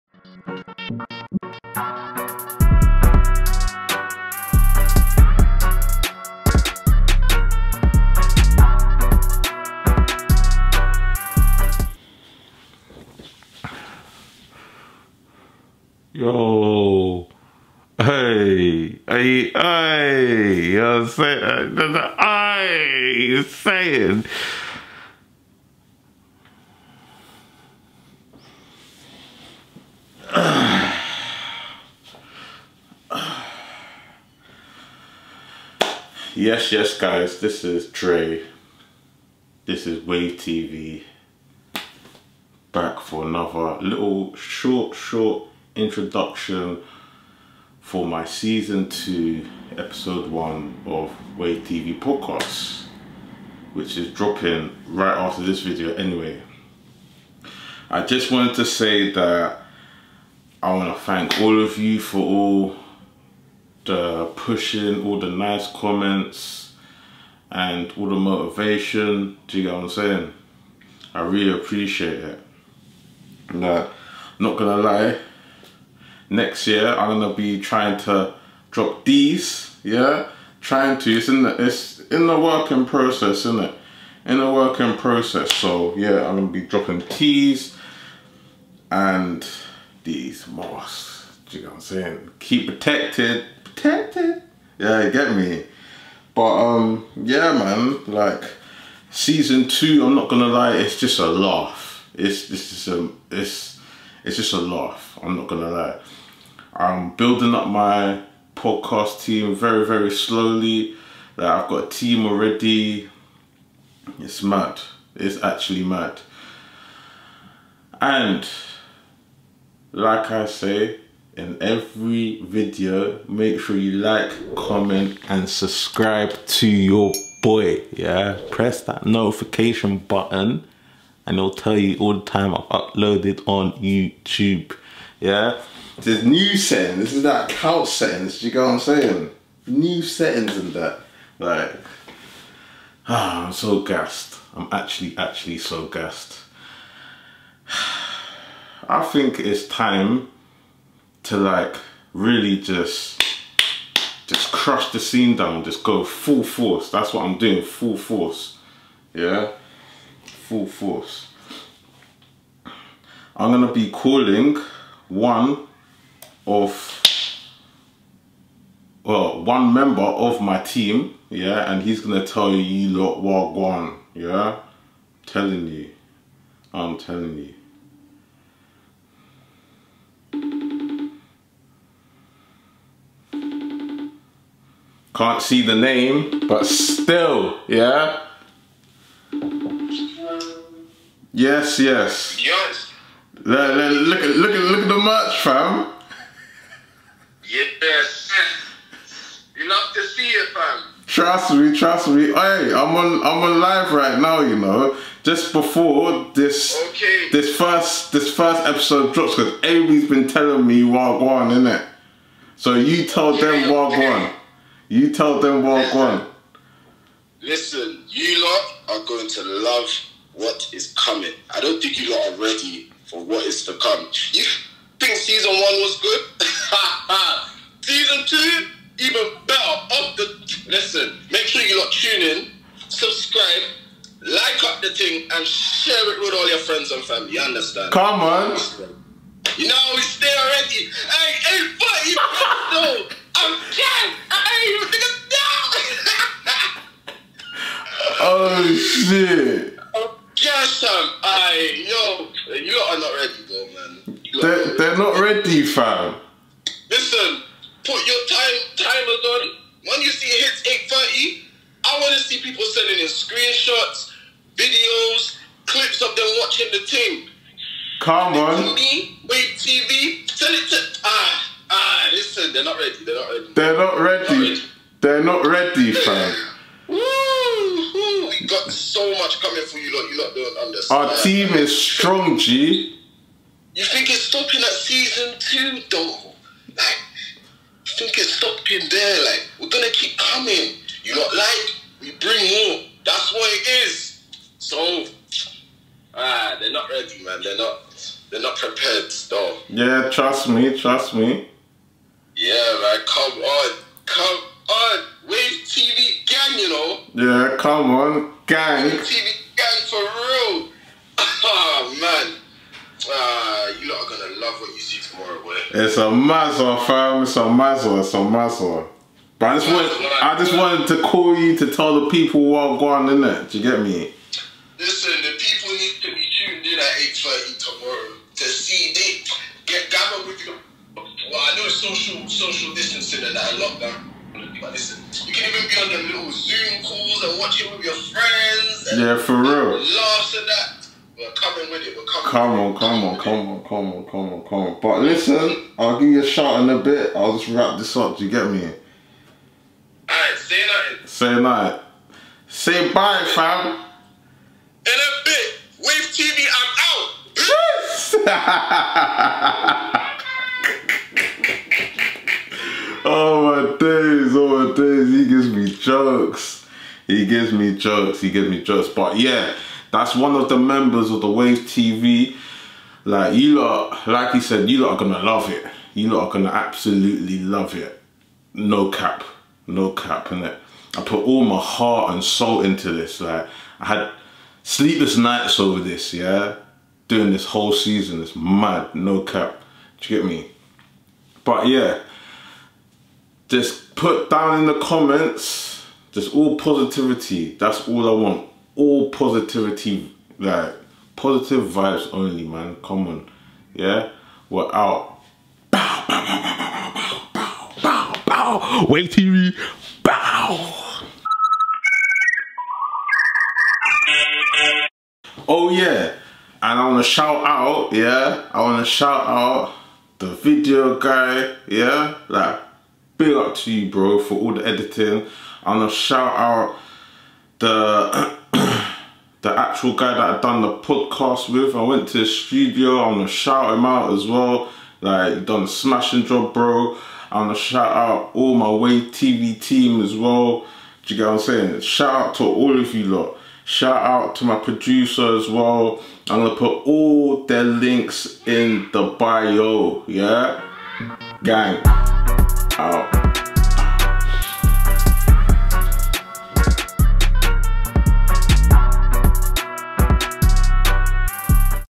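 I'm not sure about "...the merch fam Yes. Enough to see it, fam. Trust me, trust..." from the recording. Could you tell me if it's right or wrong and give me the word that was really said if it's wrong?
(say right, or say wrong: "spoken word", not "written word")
right.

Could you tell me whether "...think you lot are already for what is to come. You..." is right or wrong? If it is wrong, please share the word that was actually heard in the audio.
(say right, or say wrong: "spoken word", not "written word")
wrong: "ready", not "already".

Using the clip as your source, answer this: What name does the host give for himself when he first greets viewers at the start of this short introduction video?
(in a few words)
Dre.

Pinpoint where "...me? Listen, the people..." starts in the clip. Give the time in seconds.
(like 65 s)
323 s.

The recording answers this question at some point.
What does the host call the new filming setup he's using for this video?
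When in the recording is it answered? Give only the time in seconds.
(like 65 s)
137 s.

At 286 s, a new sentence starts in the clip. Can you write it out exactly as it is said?
Like, you think it's stopping there?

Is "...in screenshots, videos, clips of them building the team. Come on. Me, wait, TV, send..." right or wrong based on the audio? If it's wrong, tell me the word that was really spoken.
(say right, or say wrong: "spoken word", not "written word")
wrong: "watching", not "building".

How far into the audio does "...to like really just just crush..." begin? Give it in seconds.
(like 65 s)
151 s.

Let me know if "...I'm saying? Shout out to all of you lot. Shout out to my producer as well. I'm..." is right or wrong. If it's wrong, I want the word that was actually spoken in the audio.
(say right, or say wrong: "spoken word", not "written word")
right.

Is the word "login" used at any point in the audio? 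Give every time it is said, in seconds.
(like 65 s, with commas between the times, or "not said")
not said.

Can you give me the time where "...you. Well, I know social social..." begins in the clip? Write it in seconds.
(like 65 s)
330 s.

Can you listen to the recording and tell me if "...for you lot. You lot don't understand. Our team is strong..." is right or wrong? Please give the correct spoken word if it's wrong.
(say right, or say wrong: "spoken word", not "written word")
right.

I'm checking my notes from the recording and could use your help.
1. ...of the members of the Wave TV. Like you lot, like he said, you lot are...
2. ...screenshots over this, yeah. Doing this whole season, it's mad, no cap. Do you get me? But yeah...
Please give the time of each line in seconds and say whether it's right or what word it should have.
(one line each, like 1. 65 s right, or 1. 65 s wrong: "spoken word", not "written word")
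1. 370 s right
2. 385 s wrong: "nights", not "screenshots".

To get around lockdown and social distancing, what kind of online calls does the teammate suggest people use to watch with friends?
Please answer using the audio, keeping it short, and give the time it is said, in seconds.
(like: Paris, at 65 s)
Zoom calls, at 336 s.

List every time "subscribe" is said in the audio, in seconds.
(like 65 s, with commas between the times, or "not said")
125 s, 232 s.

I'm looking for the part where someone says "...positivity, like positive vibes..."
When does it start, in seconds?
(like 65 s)
399 s.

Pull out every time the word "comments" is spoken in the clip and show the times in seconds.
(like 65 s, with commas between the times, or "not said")
65 s, 124 s, 394 s.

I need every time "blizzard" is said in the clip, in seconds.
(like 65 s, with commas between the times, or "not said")
not said.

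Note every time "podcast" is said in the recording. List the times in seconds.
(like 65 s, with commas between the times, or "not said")
51 s, 108 s, 430 s.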